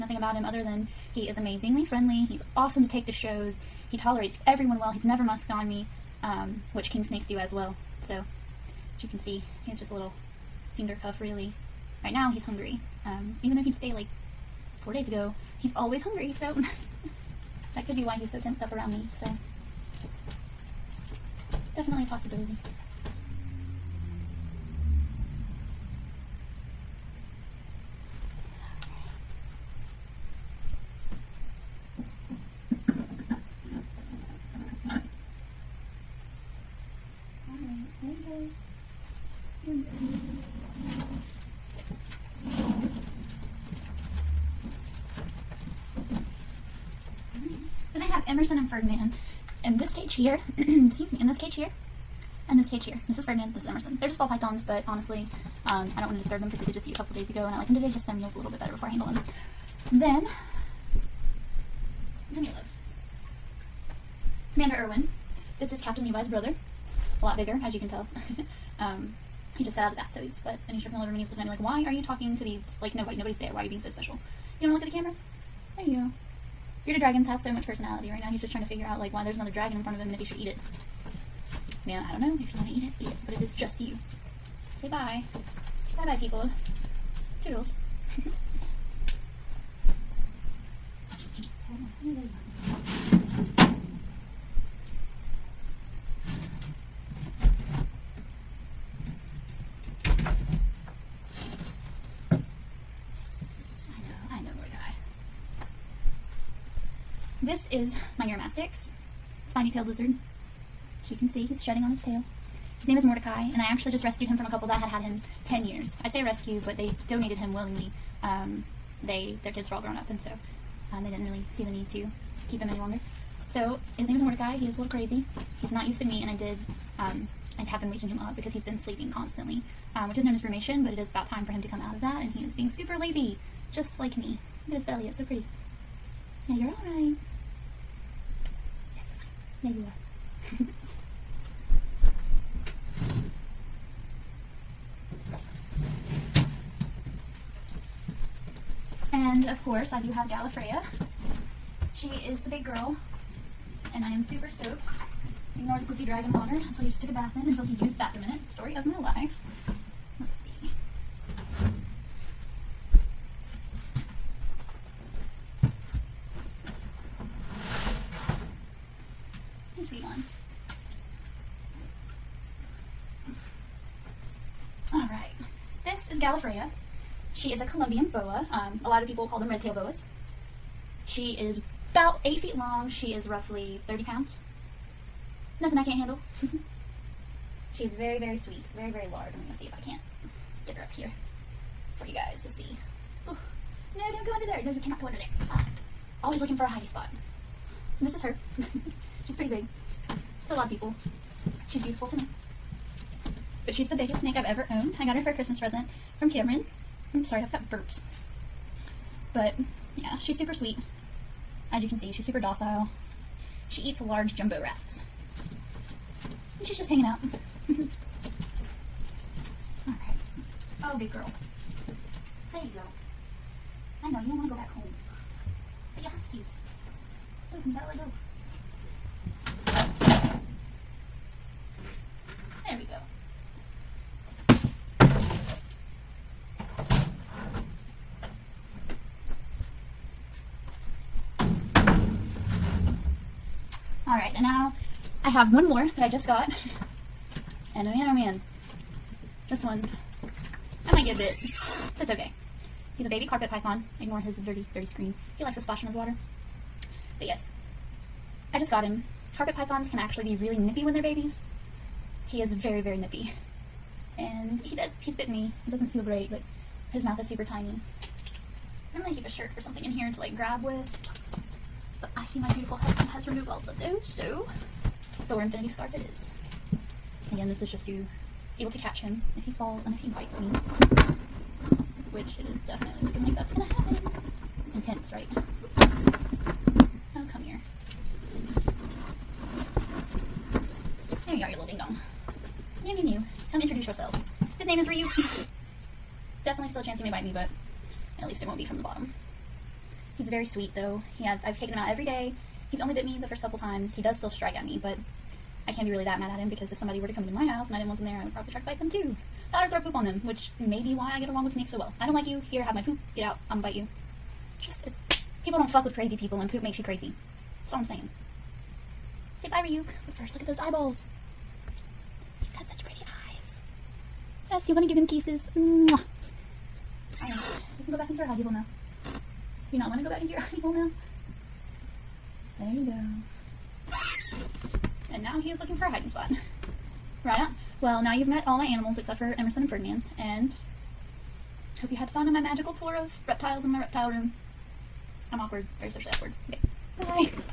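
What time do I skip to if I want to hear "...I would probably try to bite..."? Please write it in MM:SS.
05:08.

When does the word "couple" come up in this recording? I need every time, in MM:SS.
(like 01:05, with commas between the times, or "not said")
00:56, 01:54, 05:03.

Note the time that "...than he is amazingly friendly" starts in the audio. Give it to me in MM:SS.
00:00.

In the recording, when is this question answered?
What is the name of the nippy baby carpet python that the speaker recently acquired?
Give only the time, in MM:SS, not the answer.
04:54.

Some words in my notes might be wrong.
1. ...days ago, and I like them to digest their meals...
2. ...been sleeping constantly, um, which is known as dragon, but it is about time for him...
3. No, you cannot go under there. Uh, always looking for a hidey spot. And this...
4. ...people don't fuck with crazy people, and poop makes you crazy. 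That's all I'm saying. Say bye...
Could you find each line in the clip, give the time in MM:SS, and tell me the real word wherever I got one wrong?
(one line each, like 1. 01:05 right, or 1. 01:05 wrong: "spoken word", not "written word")
1. 00:57 right
2. 02:08 wrong: "brumation", not "dragon"
3. 03:14 right
4. 05:15 right.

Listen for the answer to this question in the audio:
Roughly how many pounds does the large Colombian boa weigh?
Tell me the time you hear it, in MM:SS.
03:03.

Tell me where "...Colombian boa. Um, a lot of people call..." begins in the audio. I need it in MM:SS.
02:57.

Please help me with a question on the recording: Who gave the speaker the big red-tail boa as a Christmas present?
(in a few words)
Cameron.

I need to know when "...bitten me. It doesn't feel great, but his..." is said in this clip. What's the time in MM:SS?
04:25.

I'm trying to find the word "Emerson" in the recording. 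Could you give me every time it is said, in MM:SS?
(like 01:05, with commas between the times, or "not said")
00:48, 00:53, 05:39.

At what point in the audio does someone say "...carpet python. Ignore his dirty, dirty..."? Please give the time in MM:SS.
04:13.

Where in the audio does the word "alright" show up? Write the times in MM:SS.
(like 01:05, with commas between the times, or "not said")
02:16, 03:39.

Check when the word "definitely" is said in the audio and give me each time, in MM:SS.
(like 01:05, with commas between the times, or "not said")
00:21, 04:42, 04:56.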